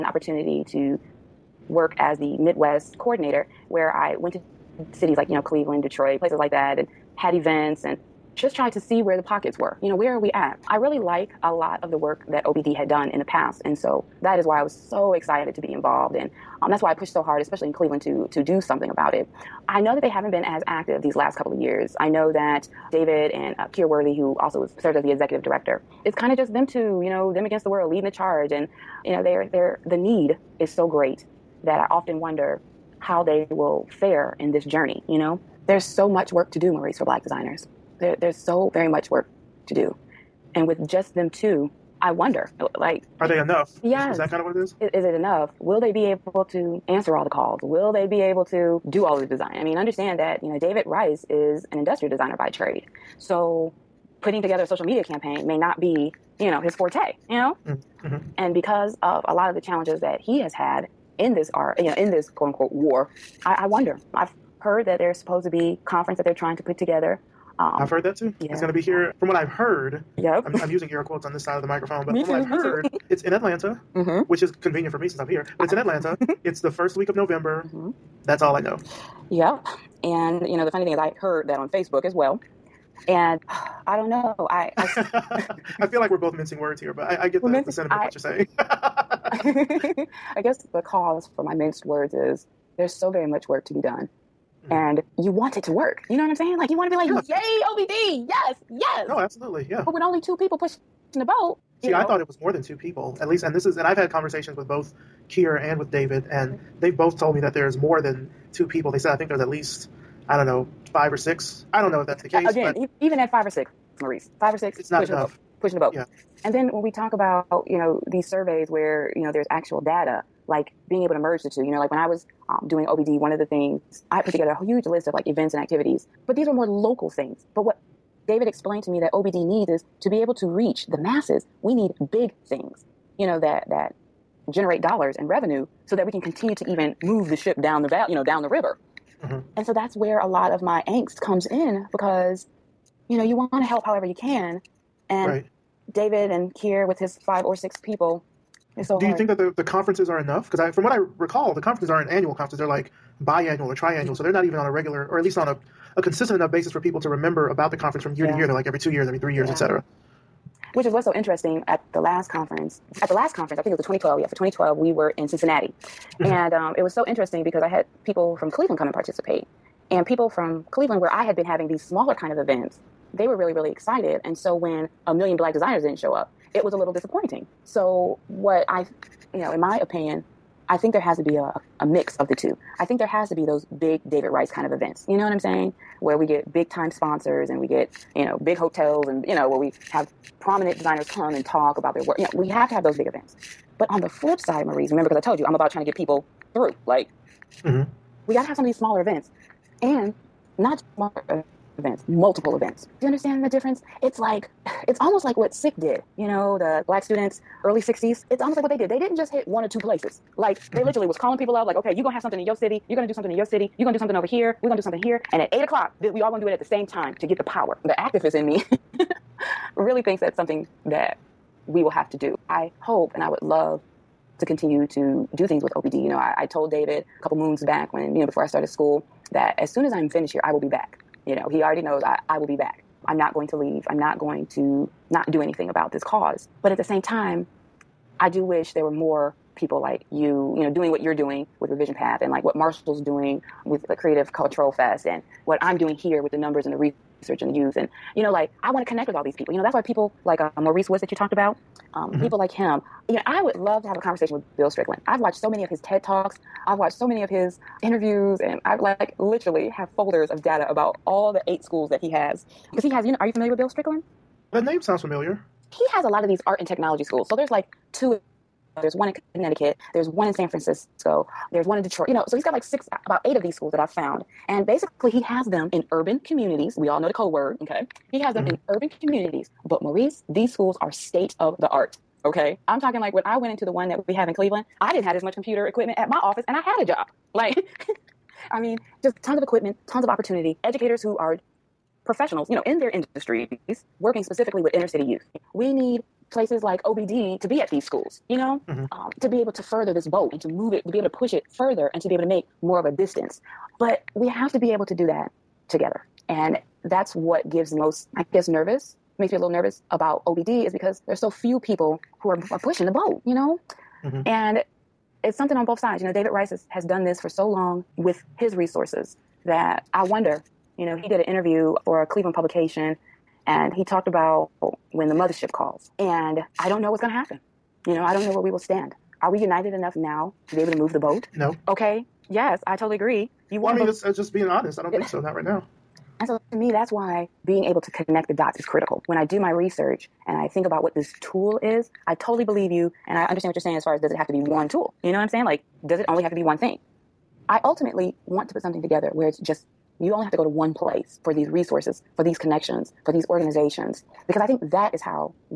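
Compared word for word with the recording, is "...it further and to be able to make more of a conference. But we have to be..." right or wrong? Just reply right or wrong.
wrong.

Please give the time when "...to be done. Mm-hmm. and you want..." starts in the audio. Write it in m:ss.
1:33.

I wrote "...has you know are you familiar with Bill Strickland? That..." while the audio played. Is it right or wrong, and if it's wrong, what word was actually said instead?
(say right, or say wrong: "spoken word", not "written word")
right.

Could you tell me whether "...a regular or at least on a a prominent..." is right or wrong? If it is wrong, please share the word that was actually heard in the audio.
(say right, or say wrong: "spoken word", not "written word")
wrong: "consistent", not "prominent".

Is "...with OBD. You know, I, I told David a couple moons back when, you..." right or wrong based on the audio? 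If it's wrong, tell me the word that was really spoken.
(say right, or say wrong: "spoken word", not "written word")
right.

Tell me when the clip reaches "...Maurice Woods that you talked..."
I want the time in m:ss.
4:10.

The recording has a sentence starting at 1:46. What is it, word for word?
they've both told me that there's more than two people.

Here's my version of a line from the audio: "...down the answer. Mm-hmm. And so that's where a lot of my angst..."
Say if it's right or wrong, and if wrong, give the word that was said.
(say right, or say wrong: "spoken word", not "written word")
wrong: "river", not "answer".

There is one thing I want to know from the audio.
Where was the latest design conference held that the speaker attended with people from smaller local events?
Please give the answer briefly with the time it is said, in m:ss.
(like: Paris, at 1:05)
Cincinnati, at 2:45.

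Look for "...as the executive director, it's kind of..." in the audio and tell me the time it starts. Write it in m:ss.
0:24.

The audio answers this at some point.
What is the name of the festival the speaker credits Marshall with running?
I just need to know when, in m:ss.
4:03.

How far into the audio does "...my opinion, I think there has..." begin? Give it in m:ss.
2:59.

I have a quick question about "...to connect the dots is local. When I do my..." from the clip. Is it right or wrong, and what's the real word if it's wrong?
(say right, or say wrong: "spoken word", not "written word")
wrong: "critical", not "local".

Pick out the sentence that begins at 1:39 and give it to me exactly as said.
But with only two people pushing the boat.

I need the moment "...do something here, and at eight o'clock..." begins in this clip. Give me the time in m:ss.
3:34.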